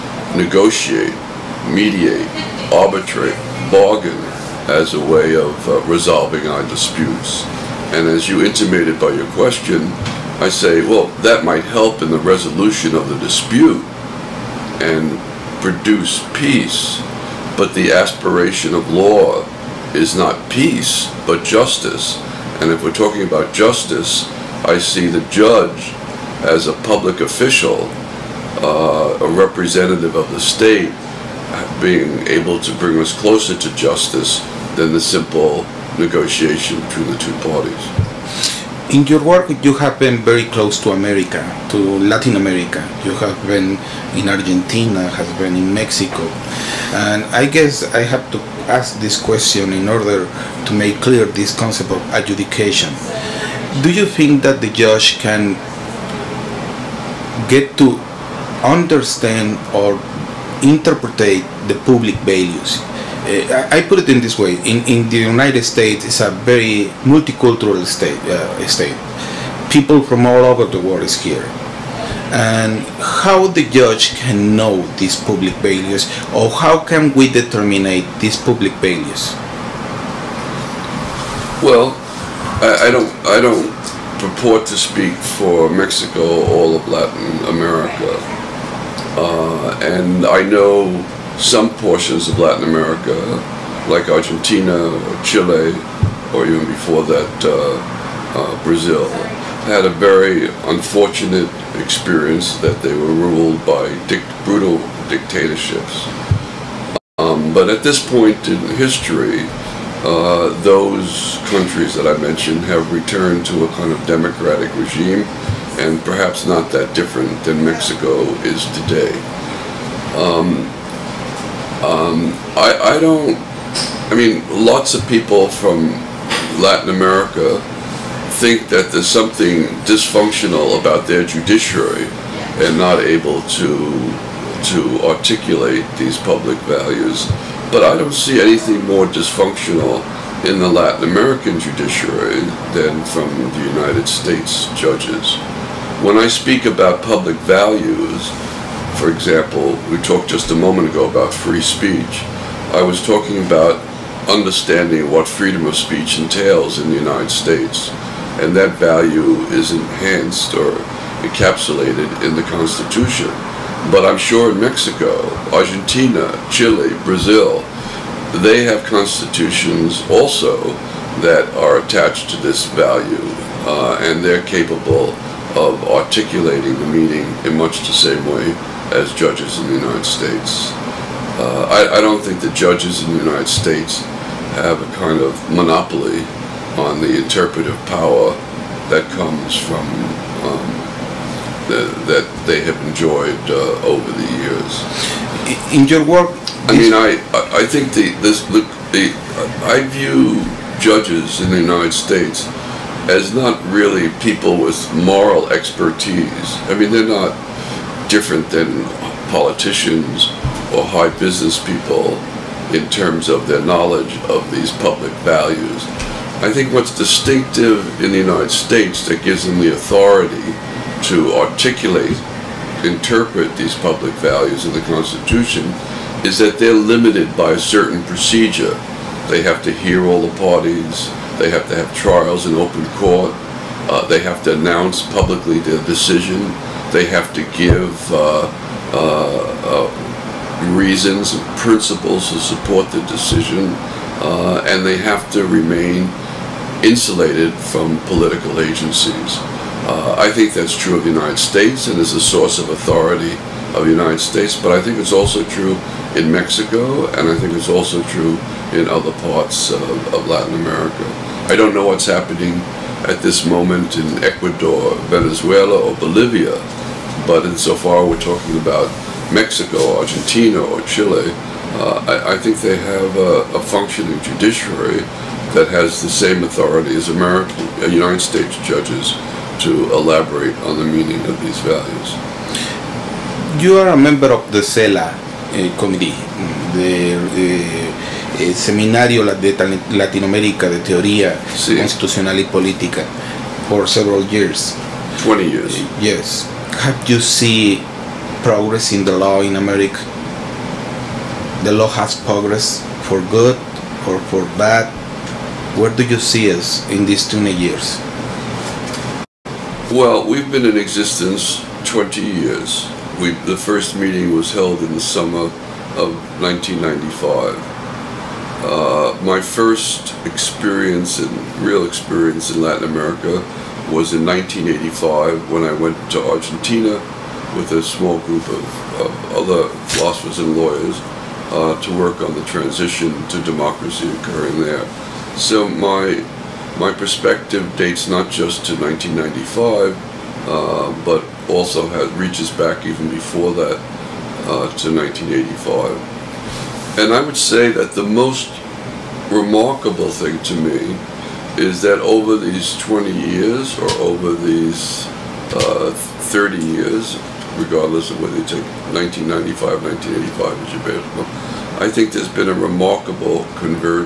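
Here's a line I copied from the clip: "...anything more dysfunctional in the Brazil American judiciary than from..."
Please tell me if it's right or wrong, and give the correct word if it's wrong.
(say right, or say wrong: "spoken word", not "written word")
wrong: "Latin", not "Brazil".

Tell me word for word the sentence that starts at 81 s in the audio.
Well, I, I don't, I don't purport to speak for Mexico, all of Latin America.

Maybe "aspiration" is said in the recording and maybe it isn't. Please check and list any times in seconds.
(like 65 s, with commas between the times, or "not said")
17 s.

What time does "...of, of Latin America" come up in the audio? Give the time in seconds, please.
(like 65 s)
259 s.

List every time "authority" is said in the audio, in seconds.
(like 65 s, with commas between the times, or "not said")
219 s, 252 s, 276 s.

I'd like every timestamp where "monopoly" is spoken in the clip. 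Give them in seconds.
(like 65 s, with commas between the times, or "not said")
185 s.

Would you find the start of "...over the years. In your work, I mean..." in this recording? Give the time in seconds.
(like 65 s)
193 s.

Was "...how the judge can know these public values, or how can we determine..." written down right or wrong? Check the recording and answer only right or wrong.
right.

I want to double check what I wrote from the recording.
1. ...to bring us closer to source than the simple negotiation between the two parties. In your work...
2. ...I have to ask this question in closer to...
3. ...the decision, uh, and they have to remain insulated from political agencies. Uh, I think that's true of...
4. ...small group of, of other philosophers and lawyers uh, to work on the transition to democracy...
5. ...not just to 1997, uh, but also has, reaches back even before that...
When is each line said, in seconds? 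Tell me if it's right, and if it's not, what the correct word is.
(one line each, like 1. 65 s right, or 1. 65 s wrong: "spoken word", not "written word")
1. 32 s wrong: "justice", not "source"
2. 47 s wrong: "order", not "closer"
3. 242 s right
4. 327 s right
5. 338 s wrong: "1995", not "1997".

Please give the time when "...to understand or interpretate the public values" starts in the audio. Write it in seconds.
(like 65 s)
57 s.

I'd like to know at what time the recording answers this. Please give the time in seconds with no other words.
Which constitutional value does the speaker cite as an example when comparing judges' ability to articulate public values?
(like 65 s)
151 s.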